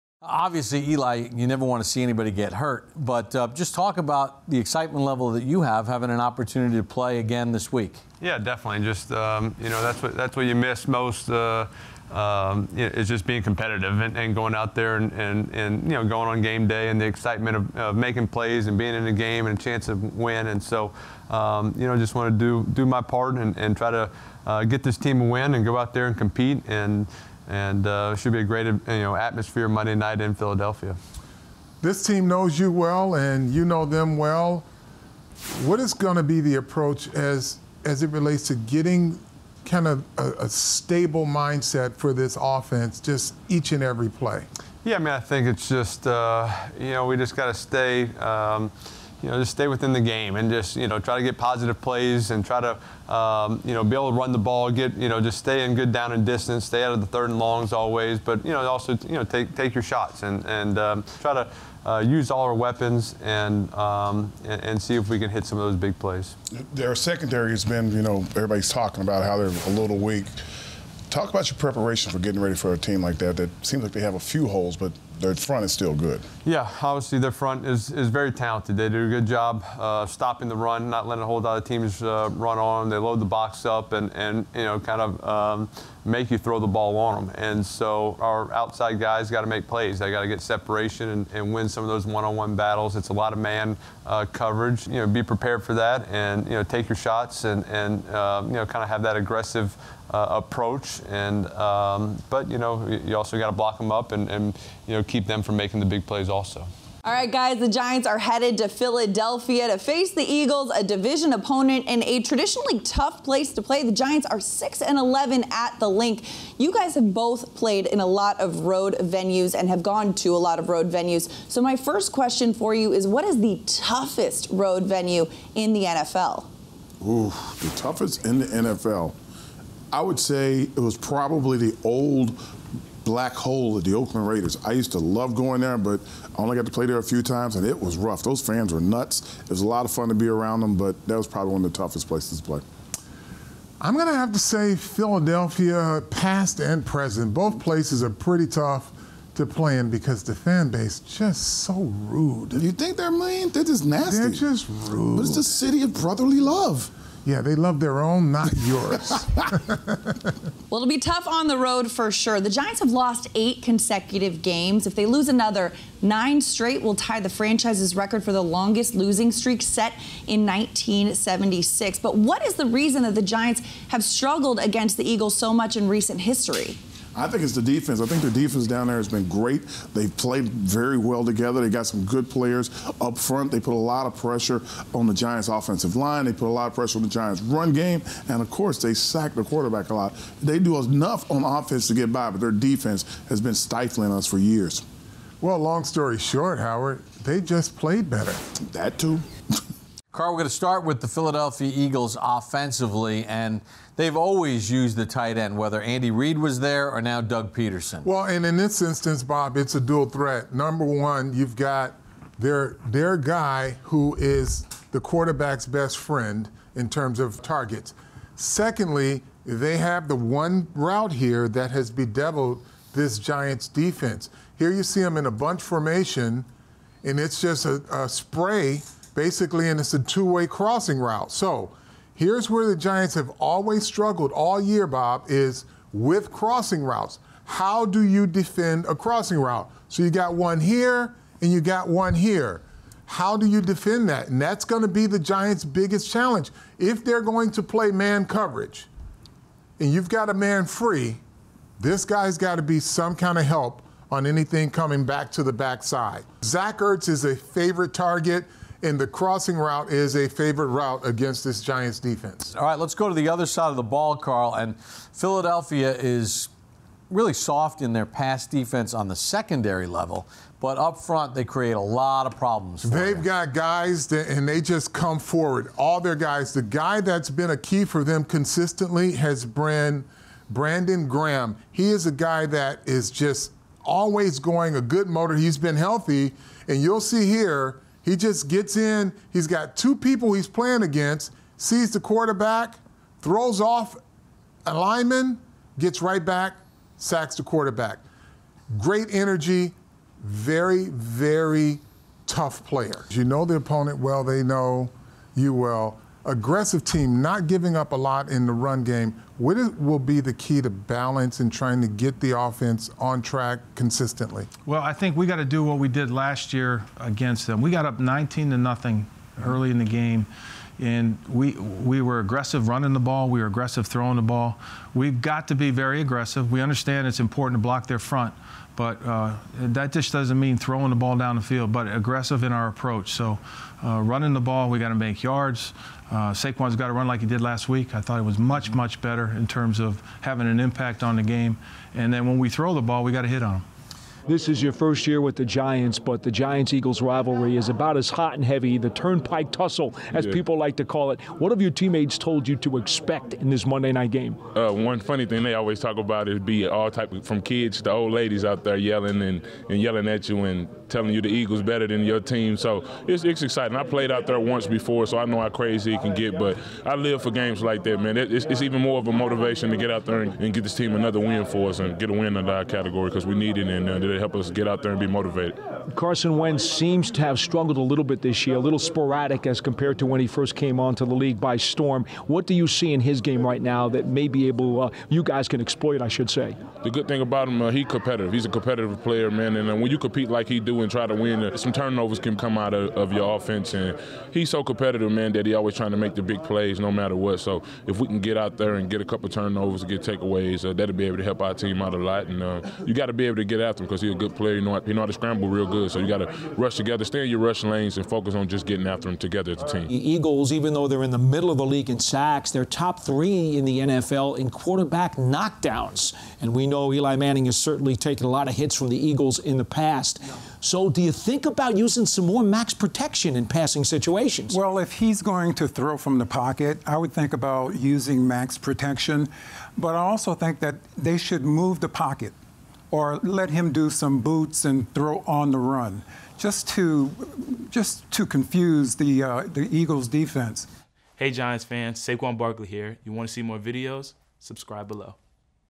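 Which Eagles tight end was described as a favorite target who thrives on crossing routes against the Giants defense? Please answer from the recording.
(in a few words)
Zach Ertz.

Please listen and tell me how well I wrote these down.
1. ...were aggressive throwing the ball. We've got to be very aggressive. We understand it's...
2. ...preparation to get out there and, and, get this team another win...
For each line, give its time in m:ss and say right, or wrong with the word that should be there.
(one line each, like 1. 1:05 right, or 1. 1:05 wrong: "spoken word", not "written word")
1. 5:23 right
2. 6:09 wrong: "motivation", not "preparation".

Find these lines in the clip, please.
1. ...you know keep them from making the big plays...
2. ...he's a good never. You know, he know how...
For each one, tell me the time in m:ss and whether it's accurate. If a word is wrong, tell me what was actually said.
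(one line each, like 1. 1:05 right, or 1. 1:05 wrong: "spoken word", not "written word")
1. 1:44 right
2. 6:44 wrong: "player", not "never".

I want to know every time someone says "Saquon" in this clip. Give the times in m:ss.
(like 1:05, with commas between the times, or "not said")
5:36, 7:21.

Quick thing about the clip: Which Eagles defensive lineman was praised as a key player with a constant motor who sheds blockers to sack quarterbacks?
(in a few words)
Brandon Graham.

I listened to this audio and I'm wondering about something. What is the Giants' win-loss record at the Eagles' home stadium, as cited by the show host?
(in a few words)
6 and 11.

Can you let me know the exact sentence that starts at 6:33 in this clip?
And he's so competitive, man, that he always trying to make the big plays no matter what.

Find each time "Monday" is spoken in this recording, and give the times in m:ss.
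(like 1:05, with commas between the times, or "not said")
0:29, 5:53.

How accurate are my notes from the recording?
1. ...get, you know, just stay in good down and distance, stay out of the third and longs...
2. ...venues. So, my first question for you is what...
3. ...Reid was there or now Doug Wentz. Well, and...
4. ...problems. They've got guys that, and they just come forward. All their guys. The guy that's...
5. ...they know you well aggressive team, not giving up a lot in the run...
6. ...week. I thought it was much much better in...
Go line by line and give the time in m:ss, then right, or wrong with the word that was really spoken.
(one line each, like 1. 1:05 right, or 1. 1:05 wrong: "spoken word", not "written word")
1. 0:54 right
2. 2:00 right
3. 3:26 wrong: "Pederson", not "Wentz"
4. 4:32 right
5. 5:04 right
6. 5:37 right.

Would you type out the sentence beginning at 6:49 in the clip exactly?
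The Eagles, even though they're in the middle of the league in sacks, they're top three in the NFL in quarterback knockdowns.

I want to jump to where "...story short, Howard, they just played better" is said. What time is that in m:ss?
3:15.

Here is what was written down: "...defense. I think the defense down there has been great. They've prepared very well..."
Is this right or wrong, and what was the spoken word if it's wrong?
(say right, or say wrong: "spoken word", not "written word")
wrong: "played", not "prepared".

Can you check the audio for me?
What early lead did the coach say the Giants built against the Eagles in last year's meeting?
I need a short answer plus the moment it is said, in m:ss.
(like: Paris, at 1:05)
19 to nothing, at 5:17.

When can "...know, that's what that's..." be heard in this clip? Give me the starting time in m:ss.
0:09.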